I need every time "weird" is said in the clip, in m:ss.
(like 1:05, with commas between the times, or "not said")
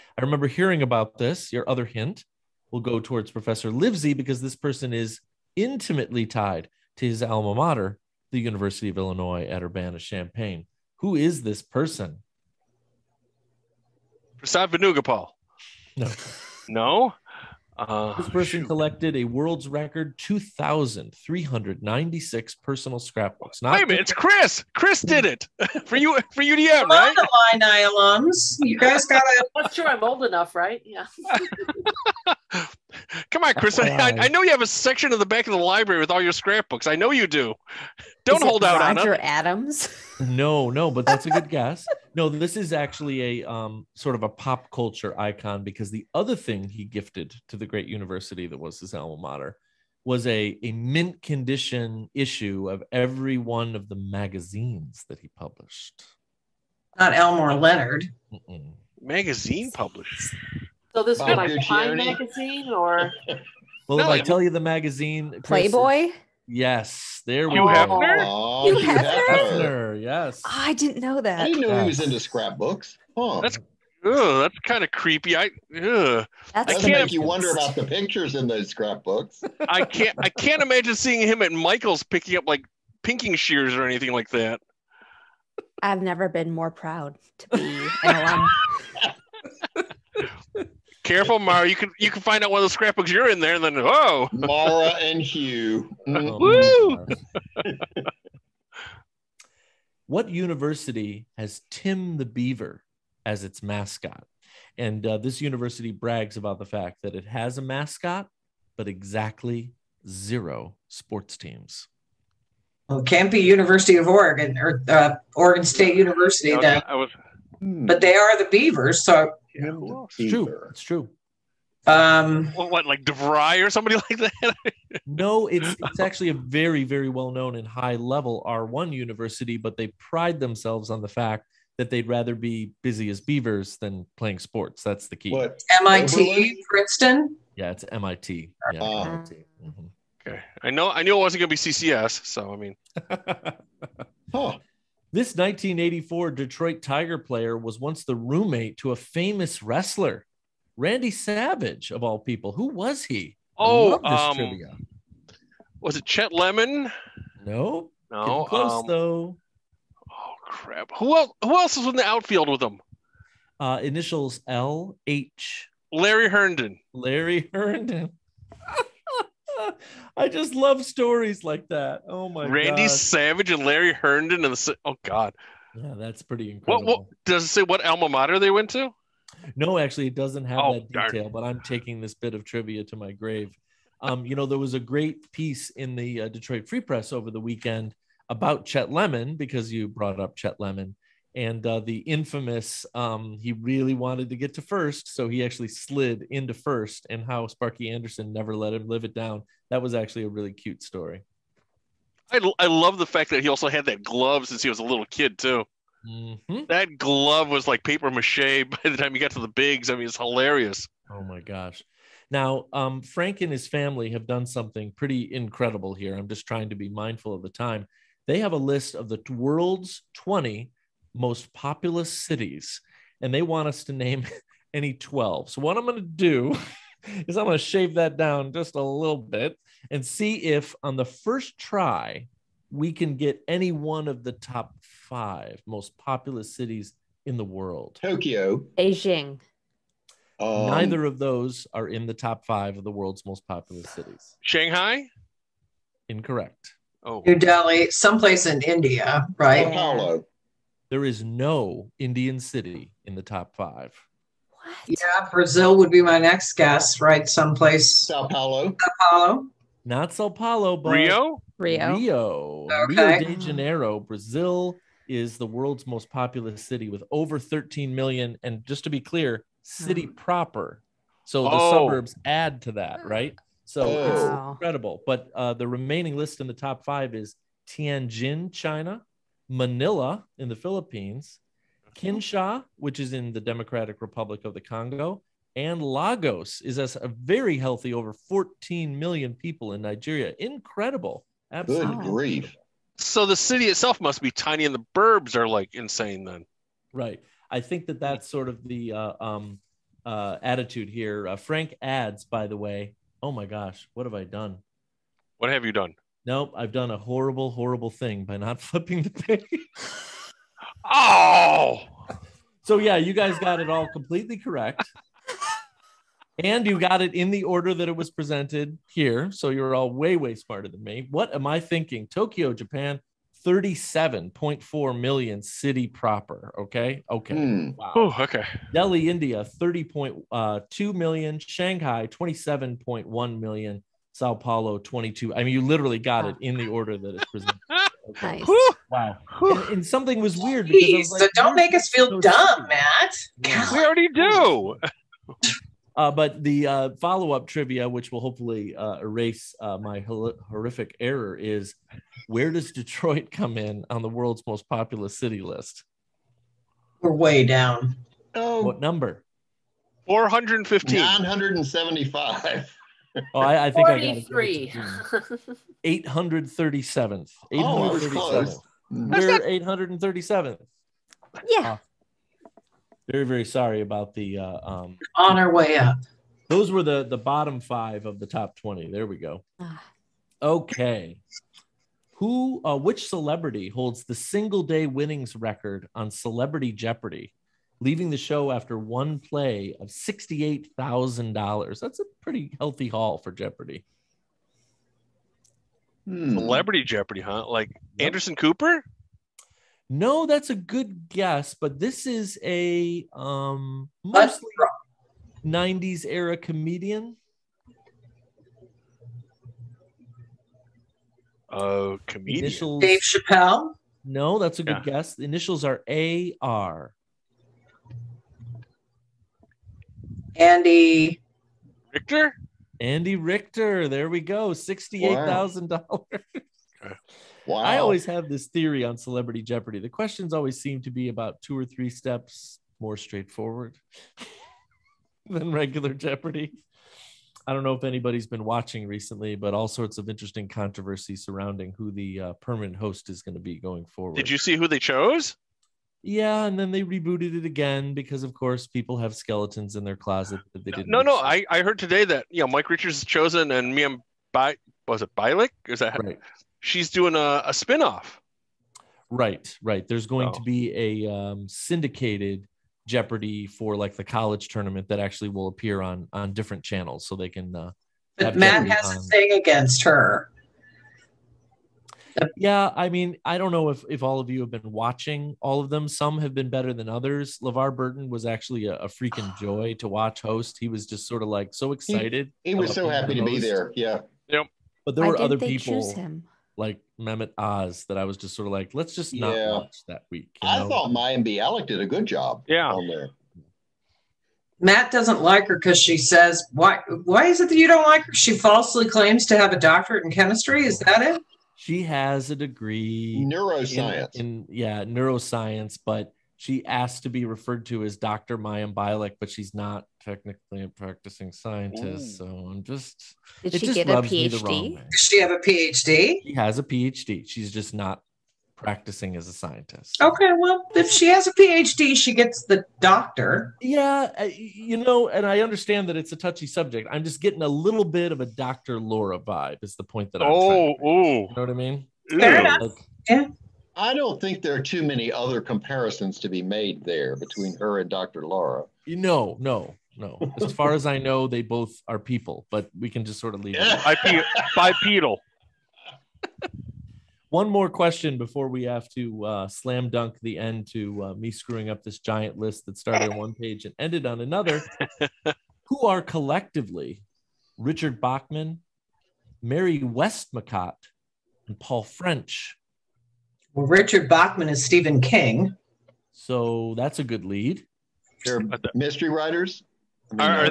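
5:40.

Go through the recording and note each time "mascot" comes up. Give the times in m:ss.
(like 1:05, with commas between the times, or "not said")
1:43, 1:47.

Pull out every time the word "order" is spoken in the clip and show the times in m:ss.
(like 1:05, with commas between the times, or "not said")
5:17, 5:36.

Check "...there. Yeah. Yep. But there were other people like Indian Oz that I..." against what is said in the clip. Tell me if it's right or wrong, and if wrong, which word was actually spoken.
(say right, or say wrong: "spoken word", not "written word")
wrong: "Mehmet", not "Indian".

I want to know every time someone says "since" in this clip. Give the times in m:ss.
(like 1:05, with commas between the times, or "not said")
3:24.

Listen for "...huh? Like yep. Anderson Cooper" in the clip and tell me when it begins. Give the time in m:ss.
6:37.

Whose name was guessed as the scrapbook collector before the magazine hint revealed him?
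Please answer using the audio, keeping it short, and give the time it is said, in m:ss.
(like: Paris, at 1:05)
Roger Adams, at 0:39.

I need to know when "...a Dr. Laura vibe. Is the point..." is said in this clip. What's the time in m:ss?
8:48.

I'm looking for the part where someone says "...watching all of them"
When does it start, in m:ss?
7:54.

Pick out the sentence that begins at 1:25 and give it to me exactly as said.
I've never been more proud to be an alum.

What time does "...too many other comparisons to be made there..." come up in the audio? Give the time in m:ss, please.
8:54.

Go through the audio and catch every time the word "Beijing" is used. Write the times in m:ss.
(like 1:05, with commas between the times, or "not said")
3:58.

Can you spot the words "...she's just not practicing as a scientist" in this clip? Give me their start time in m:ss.
8:37.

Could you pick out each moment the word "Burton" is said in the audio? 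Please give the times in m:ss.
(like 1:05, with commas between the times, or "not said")
7:57.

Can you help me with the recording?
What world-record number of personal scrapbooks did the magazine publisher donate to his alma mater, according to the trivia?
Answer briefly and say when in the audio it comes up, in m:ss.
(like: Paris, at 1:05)
2,396, at 0:20.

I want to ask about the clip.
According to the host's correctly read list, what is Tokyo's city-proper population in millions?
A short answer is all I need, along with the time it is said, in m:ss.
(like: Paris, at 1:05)
37.4 million, at 5:23.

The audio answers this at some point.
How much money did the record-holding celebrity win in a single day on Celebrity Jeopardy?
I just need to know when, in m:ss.
6:29.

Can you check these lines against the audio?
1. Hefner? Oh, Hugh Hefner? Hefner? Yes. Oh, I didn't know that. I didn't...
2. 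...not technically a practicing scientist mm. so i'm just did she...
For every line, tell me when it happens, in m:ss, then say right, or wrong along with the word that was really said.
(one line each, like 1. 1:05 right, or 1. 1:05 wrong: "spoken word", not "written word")
1. 1:07 right
2. 8:29 right.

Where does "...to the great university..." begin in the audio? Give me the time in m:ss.
0:47.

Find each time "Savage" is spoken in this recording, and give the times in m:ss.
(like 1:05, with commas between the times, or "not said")
2:31, 2:52.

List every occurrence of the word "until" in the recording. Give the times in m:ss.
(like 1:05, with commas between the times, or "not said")
not said.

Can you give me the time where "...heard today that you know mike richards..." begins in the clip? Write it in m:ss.
7:31.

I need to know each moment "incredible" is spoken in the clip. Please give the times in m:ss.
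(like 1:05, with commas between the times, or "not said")
2:56, 3:35, 4:34, 4:50.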